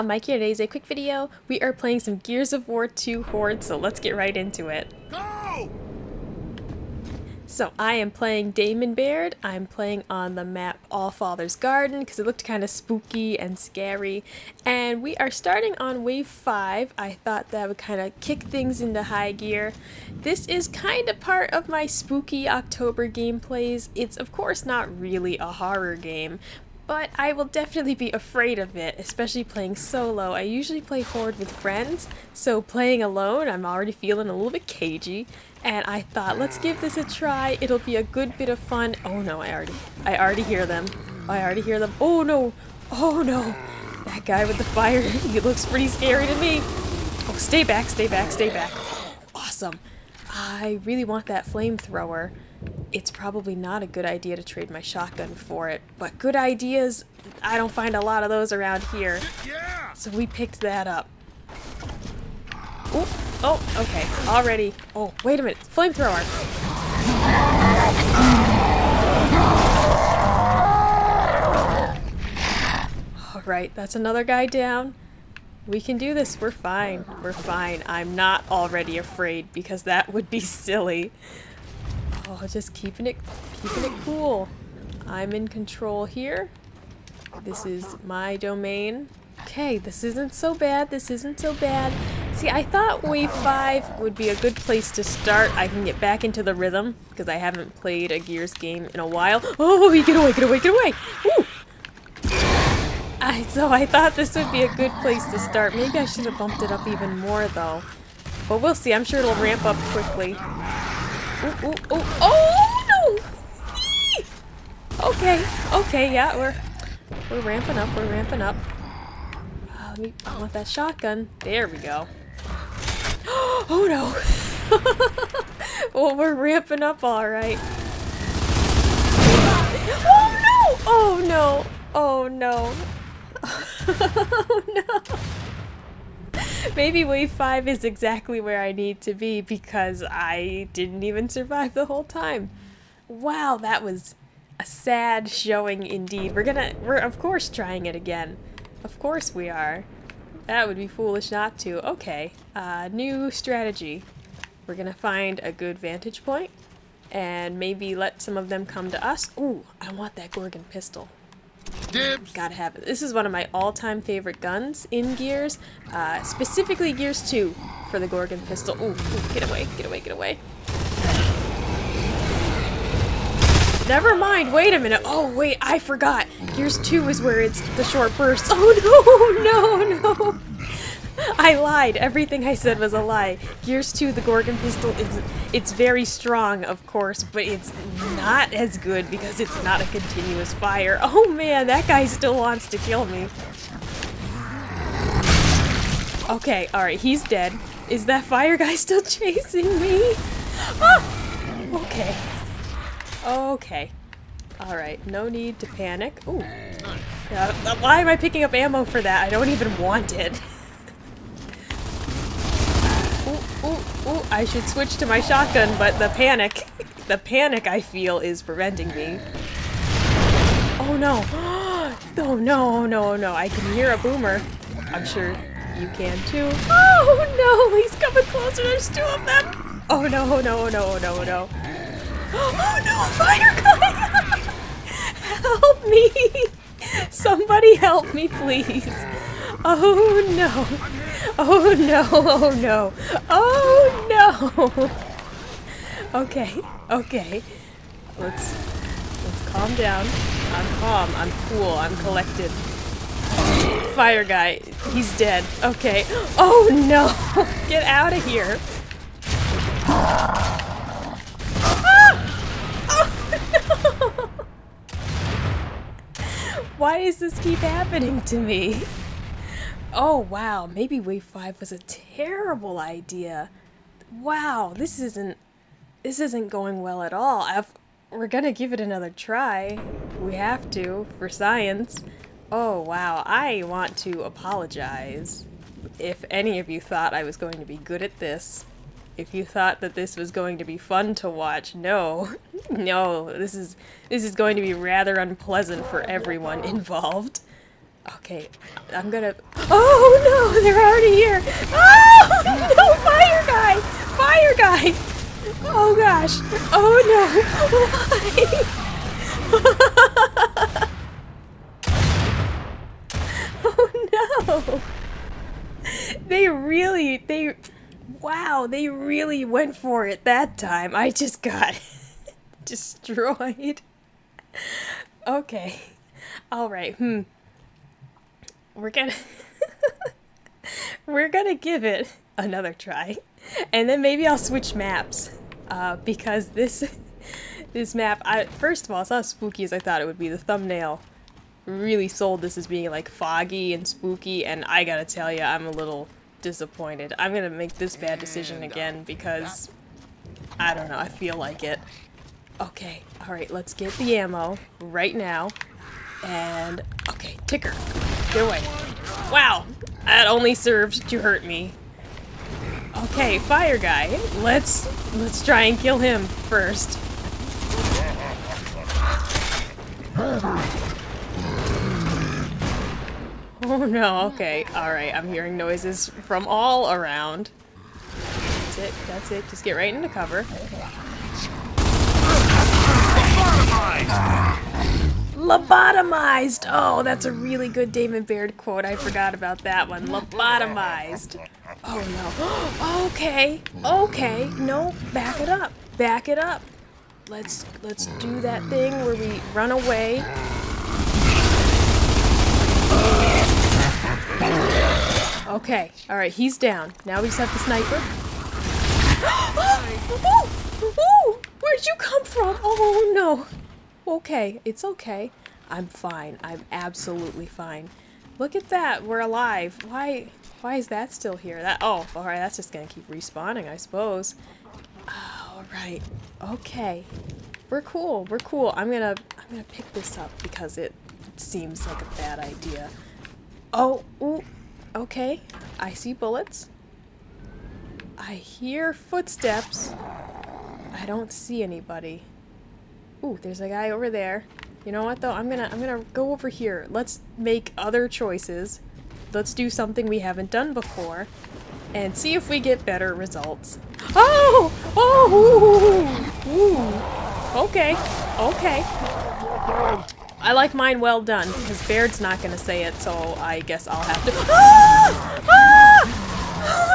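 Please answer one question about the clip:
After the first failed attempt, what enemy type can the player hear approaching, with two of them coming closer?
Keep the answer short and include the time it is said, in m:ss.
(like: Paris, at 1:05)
boomer, at 3:43.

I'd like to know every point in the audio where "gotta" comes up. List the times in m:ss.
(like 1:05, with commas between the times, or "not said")
2:42, 5:44.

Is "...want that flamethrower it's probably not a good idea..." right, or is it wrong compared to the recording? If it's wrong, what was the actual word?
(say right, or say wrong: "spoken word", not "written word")
right.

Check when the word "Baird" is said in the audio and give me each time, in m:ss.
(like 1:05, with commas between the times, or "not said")
0:08, 6:28, 7:41.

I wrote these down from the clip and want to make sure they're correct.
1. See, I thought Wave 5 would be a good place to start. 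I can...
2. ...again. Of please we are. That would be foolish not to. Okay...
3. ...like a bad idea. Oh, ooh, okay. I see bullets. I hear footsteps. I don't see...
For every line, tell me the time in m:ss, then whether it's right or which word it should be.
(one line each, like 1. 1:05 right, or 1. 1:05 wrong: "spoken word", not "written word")
1. 1:32 right
2. 2:27 wrong: "course", not "please"
3. 7:11 right.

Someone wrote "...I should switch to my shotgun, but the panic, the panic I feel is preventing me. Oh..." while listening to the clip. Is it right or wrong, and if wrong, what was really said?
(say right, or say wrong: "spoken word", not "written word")
right.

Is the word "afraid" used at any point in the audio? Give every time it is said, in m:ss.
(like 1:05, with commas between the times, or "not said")
0:28, 1:18.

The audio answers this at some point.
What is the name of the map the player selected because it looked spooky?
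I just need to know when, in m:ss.
0:10.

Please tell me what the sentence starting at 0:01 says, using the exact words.
We are playing some Gears of War 2 Horde, so let's get right into it.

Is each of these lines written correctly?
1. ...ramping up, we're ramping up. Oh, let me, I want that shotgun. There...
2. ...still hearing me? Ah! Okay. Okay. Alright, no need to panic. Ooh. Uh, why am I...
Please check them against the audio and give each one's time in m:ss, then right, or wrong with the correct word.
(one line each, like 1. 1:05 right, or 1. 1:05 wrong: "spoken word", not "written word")
1. 1:57 right
2. 3:18 wrong: "chasing", not "hearing".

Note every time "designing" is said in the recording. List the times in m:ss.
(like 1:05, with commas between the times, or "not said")
not said.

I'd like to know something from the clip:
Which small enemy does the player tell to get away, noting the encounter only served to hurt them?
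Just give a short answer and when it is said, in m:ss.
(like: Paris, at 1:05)
ticker, at 5:57.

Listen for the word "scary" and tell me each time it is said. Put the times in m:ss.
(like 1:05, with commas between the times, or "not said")
0:13, 0:45.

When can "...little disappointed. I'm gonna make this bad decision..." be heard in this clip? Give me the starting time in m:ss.
5:45.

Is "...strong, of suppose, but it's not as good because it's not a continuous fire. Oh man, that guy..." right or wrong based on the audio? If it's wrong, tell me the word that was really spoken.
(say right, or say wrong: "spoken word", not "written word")
wrong: "course", not "suppose".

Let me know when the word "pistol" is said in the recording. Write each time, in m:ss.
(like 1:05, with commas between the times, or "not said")
2:40, 2:48, 3:04.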